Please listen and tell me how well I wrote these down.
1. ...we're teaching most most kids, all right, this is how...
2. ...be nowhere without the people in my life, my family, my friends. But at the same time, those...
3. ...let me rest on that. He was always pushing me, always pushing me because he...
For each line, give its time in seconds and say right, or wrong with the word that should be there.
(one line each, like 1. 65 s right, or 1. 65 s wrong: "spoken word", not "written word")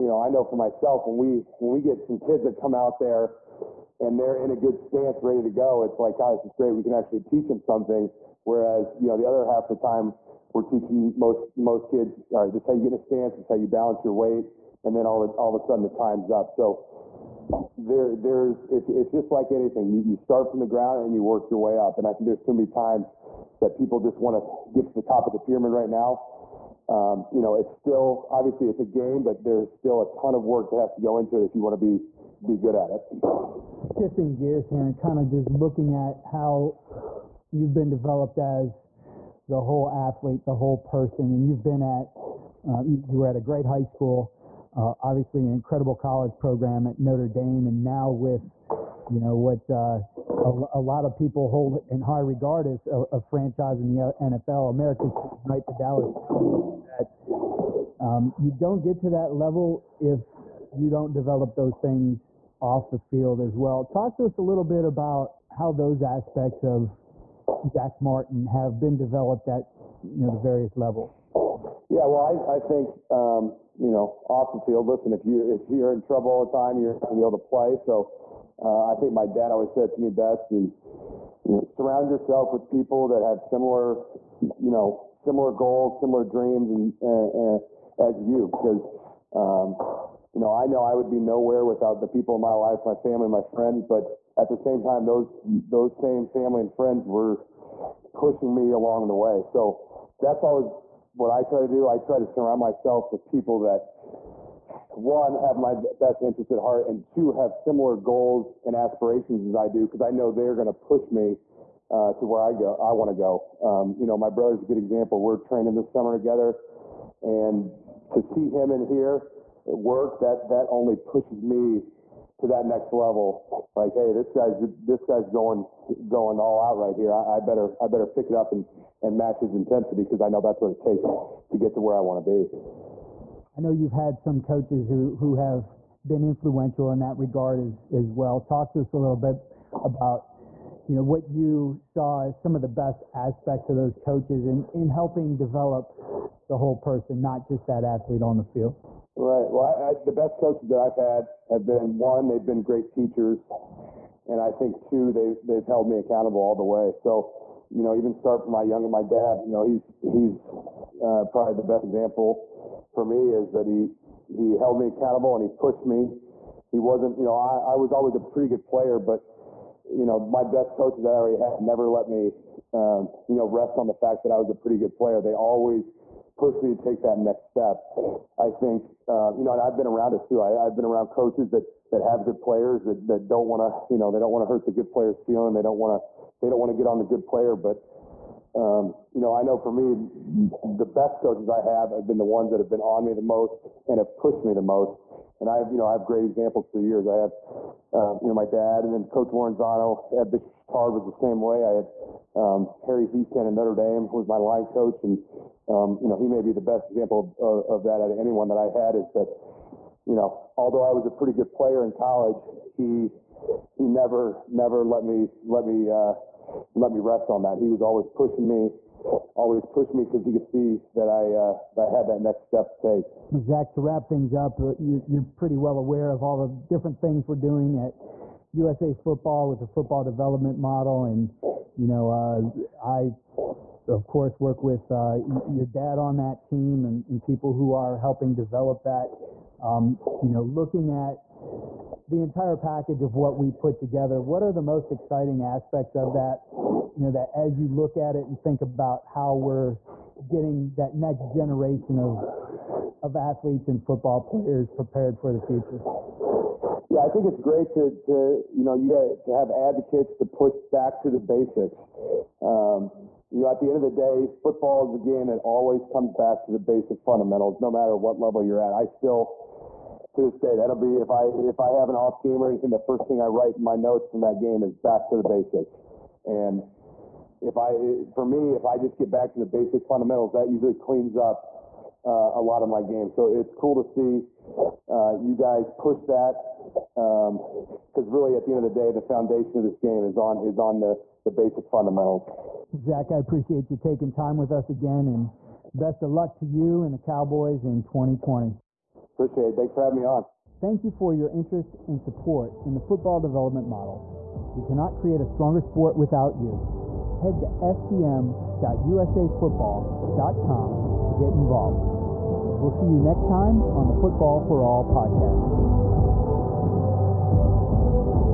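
1. 10 s right
2. 91 s right
3. 216 s right.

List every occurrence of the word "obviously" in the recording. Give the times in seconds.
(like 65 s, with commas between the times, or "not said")
28 s, 45 s.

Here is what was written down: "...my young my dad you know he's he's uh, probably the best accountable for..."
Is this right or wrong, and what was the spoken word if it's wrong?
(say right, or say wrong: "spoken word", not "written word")
wrong: "example", not "accountable".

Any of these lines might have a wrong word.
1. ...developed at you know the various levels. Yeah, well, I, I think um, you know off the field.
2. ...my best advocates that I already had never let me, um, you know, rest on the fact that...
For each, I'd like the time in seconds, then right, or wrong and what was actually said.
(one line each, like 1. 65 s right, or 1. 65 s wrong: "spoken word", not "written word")
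1. 68 s right
2. 170 s wrong: "coaches", not "advocates".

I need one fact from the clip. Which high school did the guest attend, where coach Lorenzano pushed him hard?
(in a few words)
Bishop Chatard.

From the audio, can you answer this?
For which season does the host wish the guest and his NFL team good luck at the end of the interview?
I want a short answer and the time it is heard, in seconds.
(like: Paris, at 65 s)
2020, at 297 s.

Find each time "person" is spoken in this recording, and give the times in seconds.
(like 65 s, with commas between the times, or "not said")
40 s, 146 s.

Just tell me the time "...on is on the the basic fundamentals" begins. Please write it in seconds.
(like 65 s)
290 s.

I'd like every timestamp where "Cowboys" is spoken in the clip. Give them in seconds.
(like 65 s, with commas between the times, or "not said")
56 s, 296 s.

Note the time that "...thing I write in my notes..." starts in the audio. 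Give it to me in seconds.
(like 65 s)
273 s.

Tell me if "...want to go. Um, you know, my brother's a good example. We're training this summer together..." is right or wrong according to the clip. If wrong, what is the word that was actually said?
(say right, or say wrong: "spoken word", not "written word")
right.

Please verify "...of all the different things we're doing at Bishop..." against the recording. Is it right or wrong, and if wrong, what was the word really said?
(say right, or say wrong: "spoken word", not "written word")
wrong: "USA", not "Bishop".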